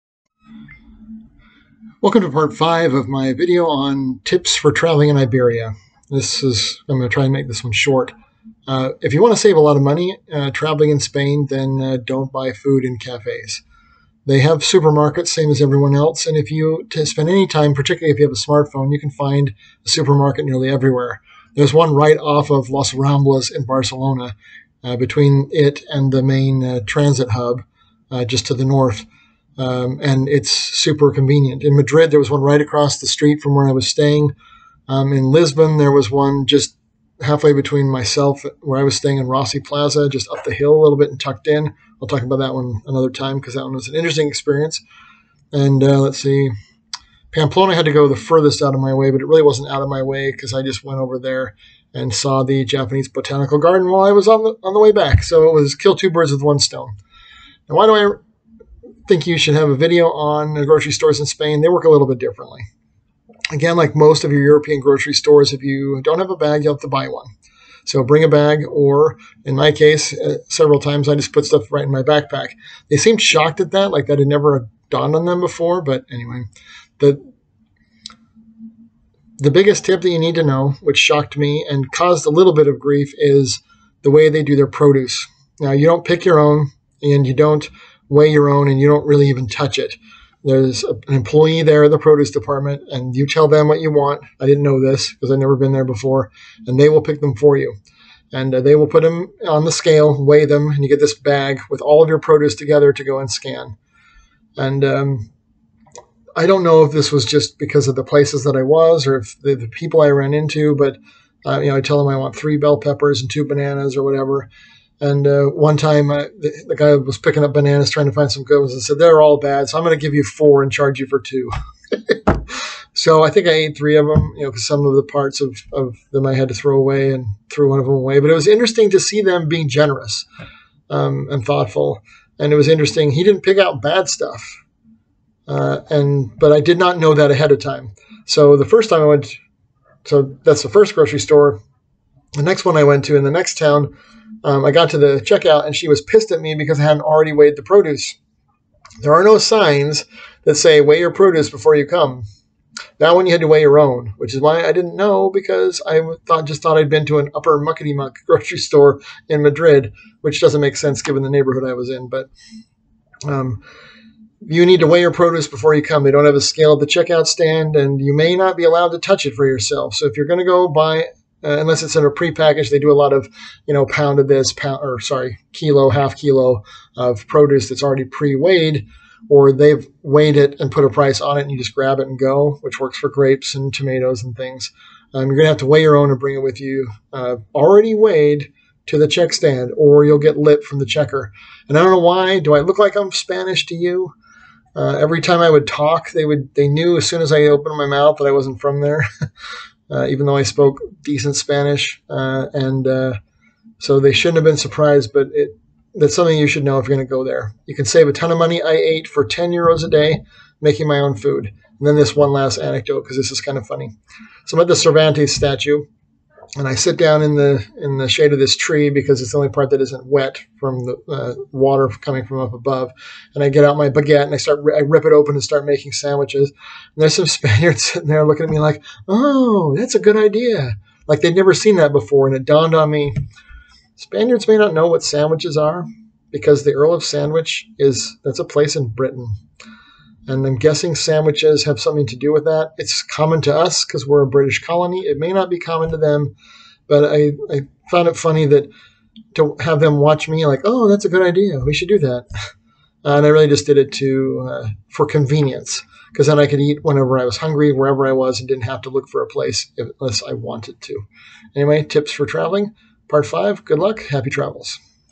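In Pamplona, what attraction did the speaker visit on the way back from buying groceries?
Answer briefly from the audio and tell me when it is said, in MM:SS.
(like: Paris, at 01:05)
Japanese botanical garden, at 00:52.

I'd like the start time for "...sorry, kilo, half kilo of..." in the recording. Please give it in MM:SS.
02:54.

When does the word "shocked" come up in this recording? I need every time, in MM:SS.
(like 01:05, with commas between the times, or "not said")
01:13, 01:20.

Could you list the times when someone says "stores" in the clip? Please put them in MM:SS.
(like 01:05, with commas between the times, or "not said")
01:00, 01:05, 02:21, 02:38.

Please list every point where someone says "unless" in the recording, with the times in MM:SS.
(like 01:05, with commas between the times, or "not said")
02:51, 04:19.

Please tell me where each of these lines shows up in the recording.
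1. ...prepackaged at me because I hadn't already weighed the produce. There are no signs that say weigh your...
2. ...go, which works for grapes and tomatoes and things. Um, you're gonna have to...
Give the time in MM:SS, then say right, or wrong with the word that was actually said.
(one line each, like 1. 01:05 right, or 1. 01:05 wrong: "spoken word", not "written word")
1. 02:26 wrong: "pissed", not "prepackaged"
2. 03:02 right.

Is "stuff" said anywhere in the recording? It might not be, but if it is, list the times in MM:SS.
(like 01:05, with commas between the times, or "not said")
01:11, 02:14.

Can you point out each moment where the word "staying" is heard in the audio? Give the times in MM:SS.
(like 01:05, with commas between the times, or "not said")
00:33, 00:38.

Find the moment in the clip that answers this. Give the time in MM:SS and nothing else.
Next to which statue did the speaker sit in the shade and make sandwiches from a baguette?
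03:34.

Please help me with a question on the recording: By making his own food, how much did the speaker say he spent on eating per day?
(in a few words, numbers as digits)
10 euros.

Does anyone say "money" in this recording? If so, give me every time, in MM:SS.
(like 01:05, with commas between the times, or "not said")
00:09, 03:28.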